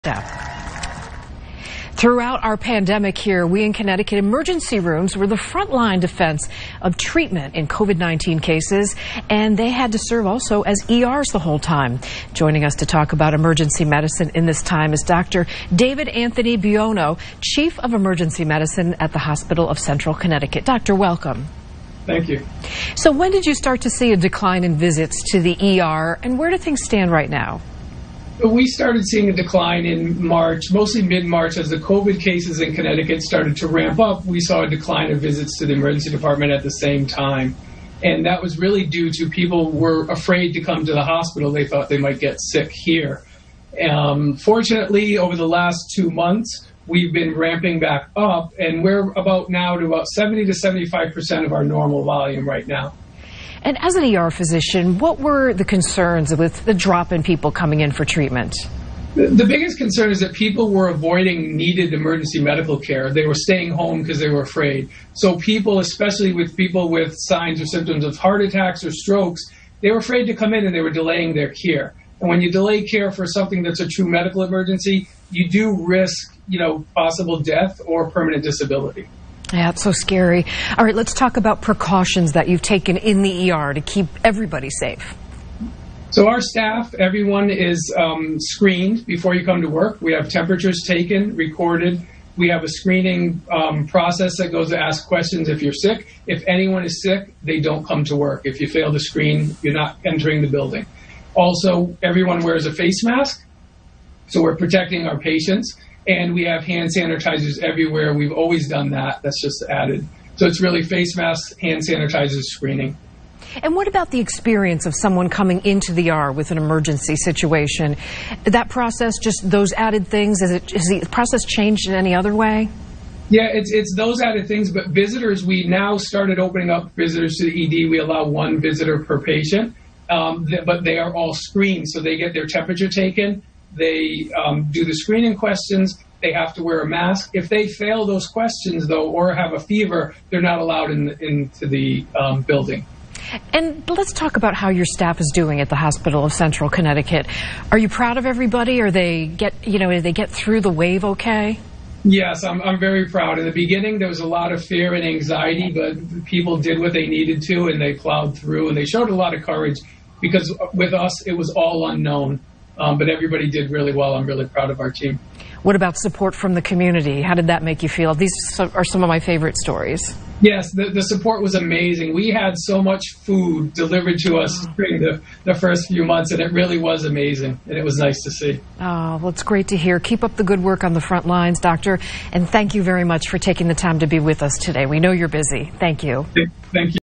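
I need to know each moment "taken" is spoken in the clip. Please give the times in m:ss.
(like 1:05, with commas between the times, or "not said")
1:22, 1:30, 2:12.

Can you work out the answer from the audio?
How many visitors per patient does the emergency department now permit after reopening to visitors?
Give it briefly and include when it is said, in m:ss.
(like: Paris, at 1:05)
1, at 2:08.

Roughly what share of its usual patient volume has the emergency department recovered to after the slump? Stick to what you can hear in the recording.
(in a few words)
70 to 75%.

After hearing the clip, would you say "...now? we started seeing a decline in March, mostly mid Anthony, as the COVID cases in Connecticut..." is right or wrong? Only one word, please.
wrong.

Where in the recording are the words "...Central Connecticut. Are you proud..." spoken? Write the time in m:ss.
2:26.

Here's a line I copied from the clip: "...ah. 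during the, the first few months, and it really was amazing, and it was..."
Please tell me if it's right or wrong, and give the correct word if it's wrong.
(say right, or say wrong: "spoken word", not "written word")
right.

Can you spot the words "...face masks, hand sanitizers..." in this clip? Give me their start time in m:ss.
1:50.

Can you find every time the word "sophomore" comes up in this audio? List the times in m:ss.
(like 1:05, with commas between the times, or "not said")
not said.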